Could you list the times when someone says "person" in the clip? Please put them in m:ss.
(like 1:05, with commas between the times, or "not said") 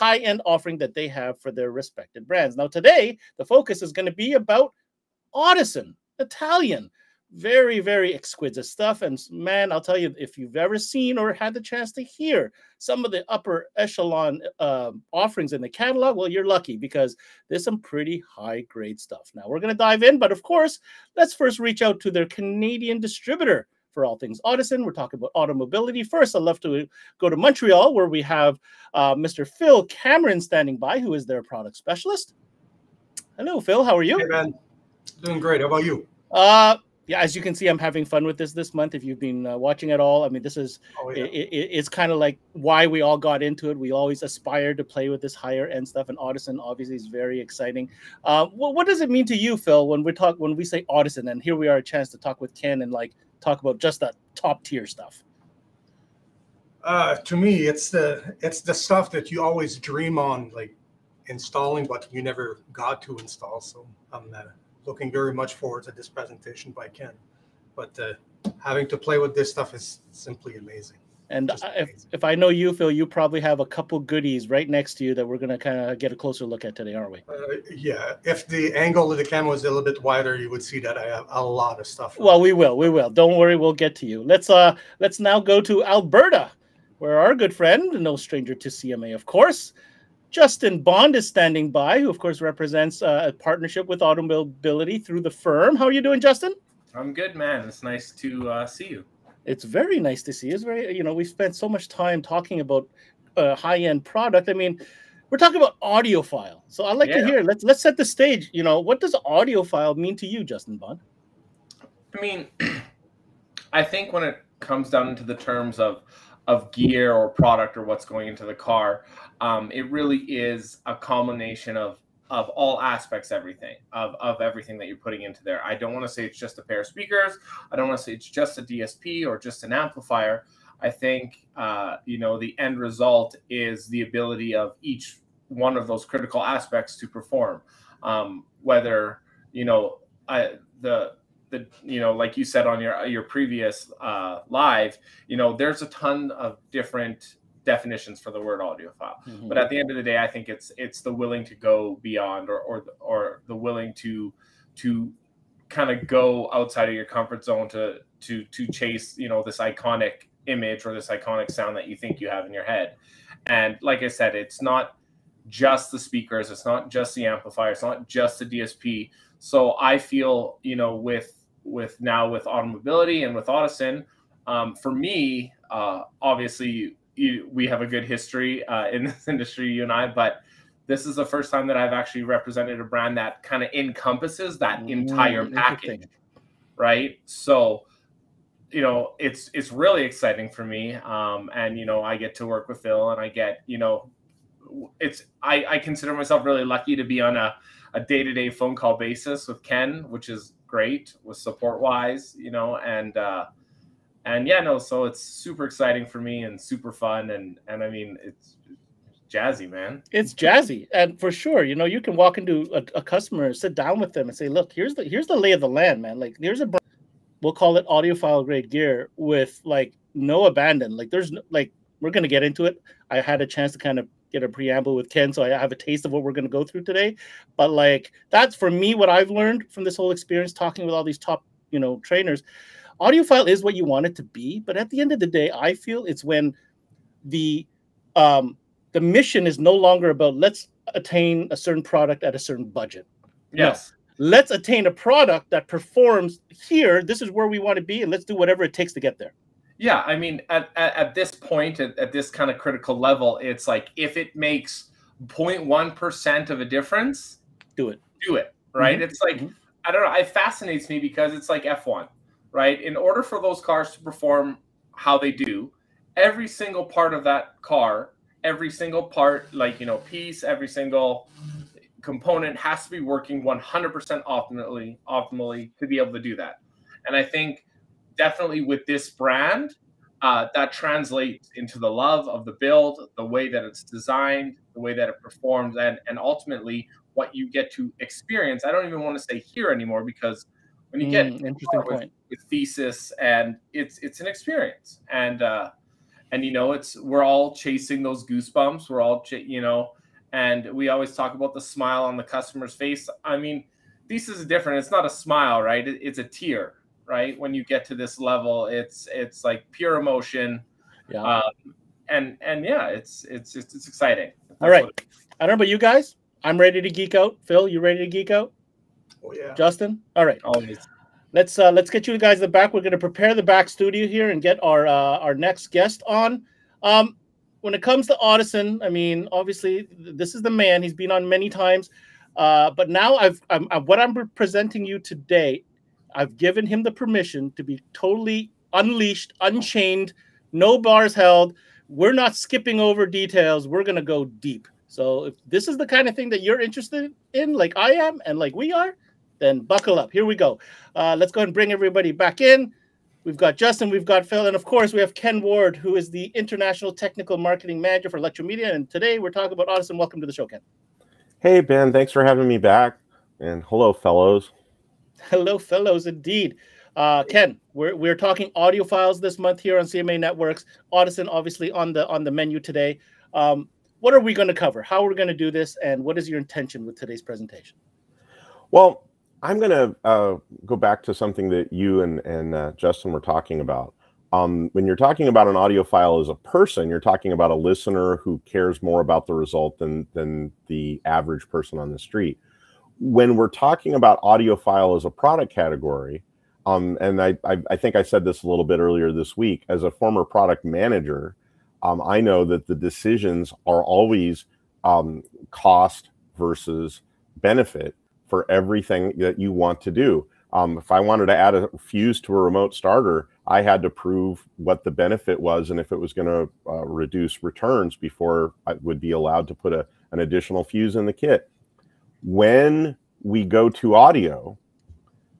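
6:26, 6:31.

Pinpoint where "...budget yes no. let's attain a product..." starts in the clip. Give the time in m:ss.
4:02.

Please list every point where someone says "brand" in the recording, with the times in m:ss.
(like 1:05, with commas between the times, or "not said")
0:02, 3:02, 4:39.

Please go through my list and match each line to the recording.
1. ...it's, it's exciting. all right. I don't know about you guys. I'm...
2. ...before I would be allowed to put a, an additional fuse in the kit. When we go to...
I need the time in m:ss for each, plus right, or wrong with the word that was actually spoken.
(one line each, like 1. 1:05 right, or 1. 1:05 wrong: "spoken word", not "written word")
1. 5:13 right
2. 6:57 right.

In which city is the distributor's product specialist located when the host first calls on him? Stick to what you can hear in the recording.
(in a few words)
Montreal.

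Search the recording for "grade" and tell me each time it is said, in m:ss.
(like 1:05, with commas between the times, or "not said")
0:18, 3:38.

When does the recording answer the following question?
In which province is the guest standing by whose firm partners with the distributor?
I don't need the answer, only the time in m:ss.
1:25.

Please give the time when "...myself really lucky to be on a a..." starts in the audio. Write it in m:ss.
3:16.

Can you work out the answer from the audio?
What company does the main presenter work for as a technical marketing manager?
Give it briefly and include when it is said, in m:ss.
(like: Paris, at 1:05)
ElectroMedia, at 5:58.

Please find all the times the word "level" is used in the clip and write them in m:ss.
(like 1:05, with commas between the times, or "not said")
4:12, 5:08.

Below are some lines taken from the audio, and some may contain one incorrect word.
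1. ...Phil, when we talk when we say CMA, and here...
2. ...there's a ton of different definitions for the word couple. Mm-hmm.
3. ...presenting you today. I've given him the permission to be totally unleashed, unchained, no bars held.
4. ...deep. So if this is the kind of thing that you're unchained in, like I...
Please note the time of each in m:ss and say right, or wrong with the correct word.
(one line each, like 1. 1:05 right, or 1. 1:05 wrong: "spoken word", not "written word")
1. 0:49 wrong: "Audison", not "CMA"
2. 2:25 wrong: "audiophile", not "couple"
3. 5:34 right
4. 5:44 wrong: "interested", not "unchained".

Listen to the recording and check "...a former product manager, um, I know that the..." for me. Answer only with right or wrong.
right.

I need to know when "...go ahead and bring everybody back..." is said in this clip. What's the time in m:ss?
5:51.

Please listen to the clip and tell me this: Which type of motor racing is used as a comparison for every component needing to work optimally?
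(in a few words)
F1.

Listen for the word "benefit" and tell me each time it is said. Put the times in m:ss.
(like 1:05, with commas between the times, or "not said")
6:47, 6:54.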